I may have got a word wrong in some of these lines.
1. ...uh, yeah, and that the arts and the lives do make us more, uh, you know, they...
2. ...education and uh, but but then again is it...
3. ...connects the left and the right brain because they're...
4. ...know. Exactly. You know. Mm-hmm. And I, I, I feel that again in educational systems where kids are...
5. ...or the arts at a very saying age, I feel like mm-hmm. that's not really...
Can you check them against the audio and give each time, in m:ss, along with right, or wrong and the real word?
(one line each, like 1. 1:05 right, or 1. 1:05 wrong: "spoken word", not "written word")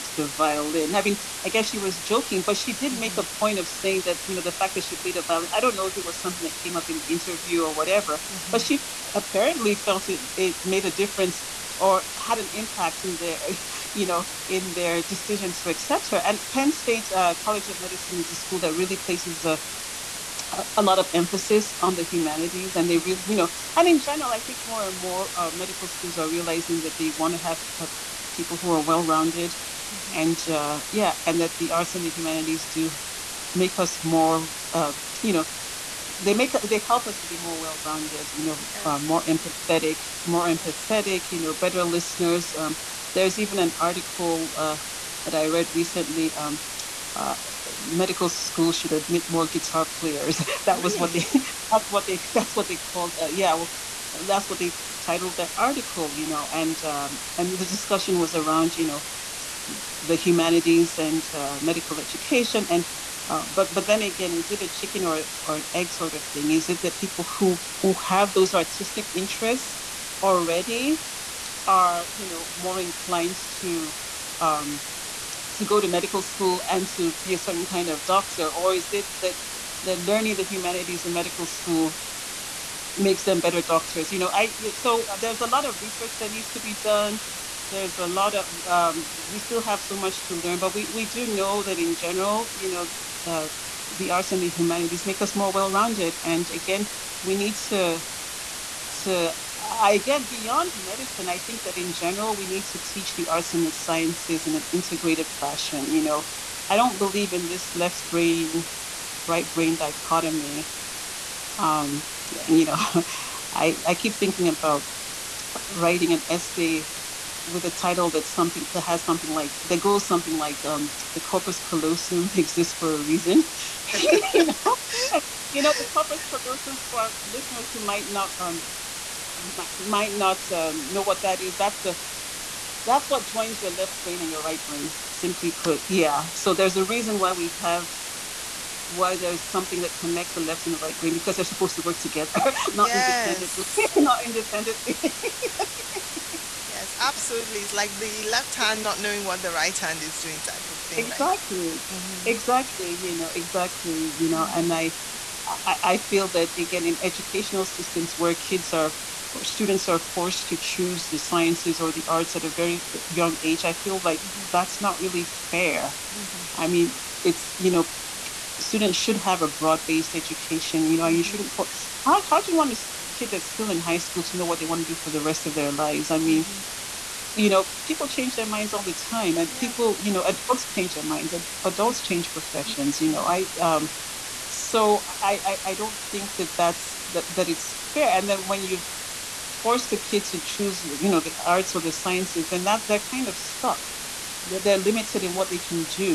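1. 0:30 wrong: "humanities", not "lives"
2. 1:01 right
3. 2:19 right
4. 2:33 right
5. 2:41 wrong: "young", not "saying".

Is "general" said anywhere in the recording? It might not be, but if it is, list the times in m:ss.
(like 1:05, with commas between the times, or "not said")
0:23, 1:31, 1:41.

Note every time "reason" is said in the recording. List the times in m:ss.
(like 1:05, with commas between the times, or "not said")
2:03, 2:16.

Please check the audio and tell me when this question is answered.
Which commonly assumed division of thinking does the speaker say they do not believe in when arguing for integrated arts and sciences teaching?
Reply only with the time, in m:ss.
1:47.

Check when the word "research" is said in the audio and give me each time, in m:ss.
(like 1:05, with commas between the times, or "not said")
1:25.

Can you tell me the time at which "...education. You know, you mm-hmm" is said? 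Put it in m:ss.
2:50.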